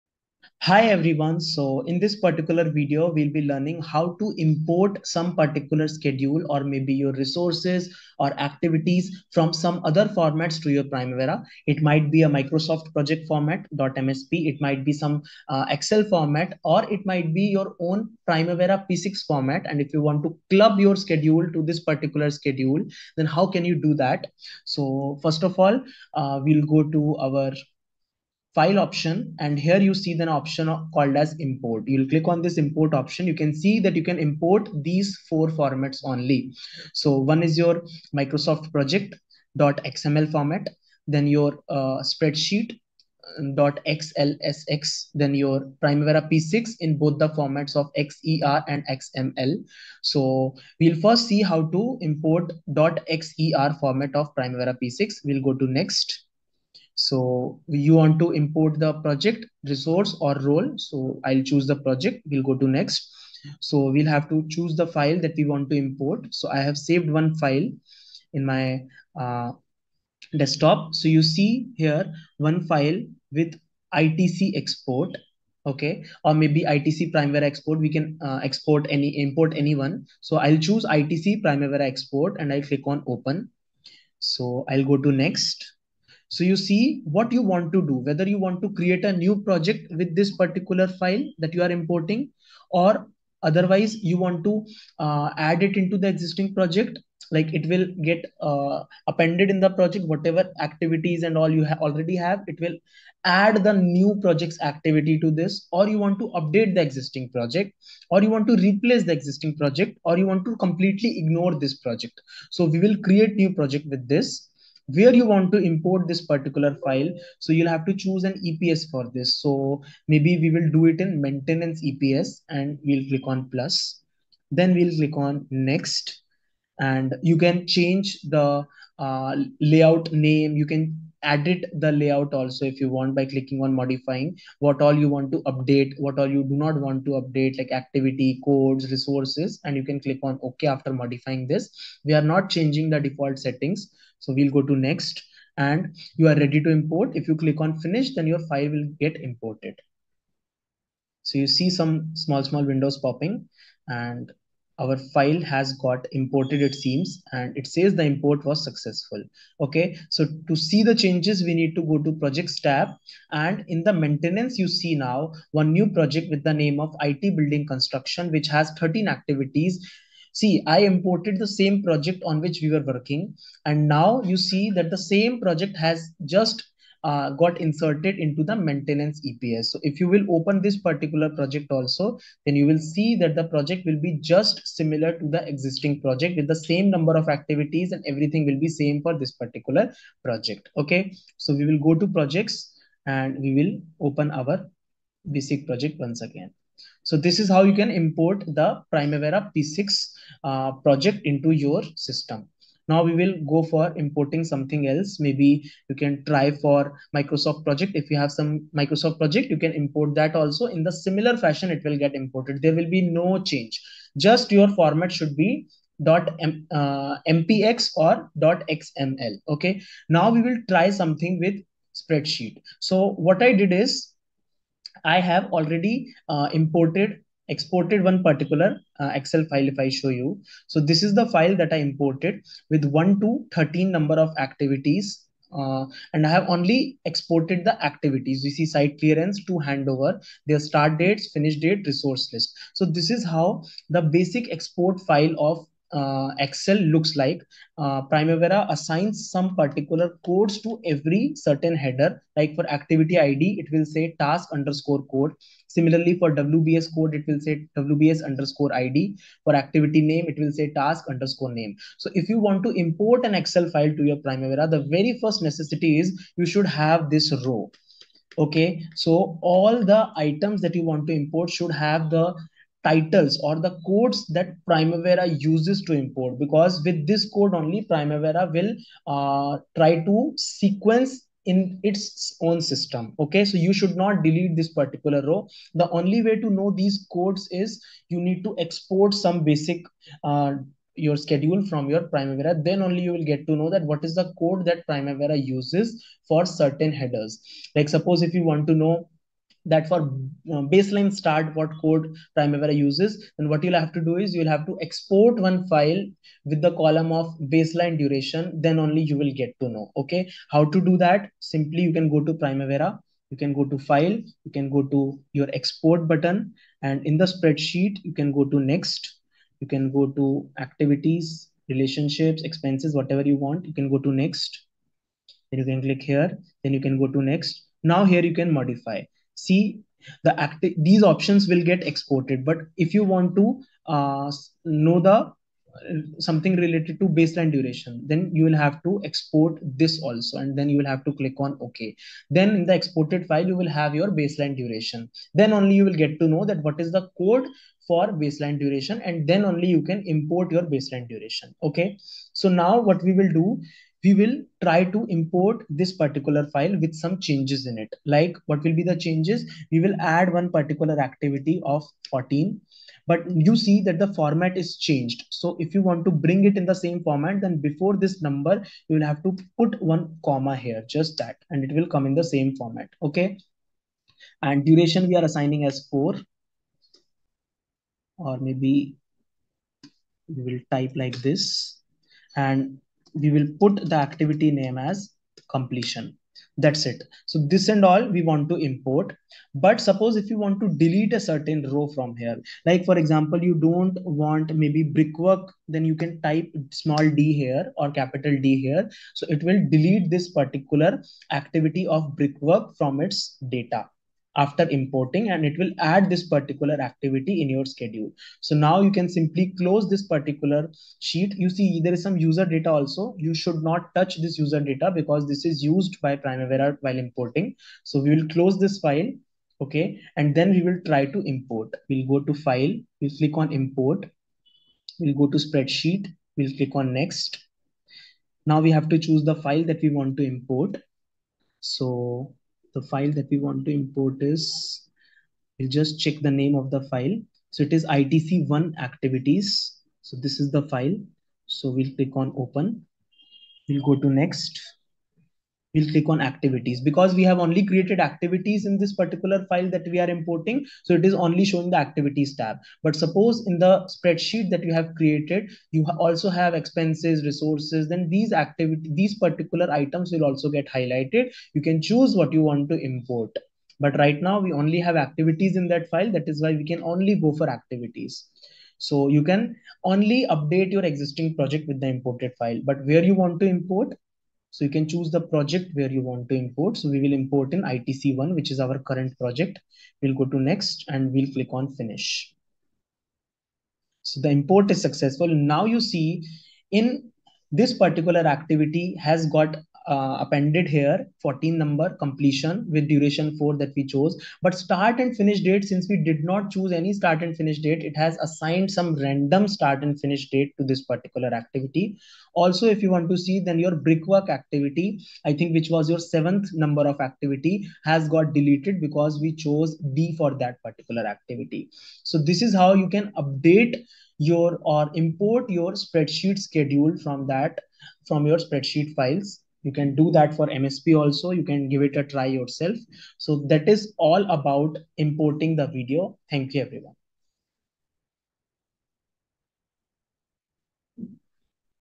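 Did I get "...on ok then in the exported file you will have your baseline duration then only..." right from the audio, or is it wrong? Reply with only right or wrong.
right.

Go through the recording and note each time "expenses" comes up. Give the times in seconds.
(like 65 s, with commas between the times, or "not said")
322 s, 456 s.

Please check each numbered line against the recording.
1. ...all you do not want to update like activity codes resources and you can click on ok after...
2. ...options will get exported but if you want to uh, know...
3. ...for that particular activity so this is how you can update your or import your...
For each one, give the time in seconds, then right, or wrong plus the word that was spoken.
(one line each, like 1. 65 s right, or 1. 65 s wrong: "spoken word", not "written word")
1. 136 s right
2. 331 s right
3. 510 s right.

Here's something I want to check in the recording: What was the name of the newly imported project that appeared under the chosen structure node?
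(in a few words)
IT building construction.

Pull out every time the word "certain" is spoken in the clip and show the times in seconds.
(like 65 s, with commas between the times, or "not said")
251 s, 296 s, 391 s.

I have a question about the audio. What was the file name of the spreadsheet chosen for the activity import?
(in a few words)
ITC1 activities.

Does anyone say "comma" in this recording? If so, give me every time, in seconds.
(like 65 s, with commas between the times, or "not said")
370 s.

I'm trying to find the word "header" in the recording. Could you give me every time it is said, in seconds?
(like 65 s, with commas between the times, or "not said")
251 s, 296 s.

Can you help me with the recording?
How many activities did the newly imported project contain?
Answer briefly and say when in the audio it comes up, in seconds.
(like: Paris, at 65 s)
13, at 168 s.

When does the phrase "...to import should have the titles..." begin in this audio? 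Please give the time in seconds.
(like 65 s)
271 s.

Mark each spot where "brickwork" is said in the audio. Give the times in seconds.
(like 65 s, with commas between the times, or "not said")
394 s, 402 s, 503 s.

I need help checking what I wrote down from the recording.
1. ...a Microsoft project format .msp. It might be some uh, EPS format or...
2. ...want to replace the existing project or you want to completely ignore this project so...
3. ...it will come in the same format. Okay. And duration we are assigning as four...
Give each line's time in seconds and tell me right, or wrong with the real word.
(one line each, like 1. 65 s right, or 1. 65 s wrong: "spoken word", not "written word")
1. 12 s wrong: "Excel", not "EPS"
2. 108 s right
3. 371 s right.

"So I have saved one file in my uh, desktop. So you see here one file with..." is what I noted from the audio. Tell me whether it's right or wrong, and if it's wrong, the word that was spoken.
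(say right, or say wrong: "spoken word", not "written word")
right.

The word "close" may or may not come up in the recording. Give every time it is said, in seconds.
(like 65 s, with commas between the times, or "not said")
409 s, 418 s.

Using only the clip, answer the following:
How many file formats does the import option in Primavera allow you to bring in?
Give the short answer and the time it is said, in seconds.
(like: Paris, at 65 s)
4, at 35 s.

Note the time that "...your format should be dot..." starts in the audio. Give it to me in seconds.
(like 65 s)
214 s.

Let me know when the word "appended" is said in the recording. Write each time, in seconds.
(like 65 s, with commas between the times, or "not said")
99 s, 490 s.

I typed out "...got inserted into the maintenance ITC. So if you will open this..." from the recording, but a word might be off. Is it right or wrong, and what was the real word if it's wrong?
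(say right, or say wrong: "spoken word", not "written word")
wrong: "EPS", not "ITC".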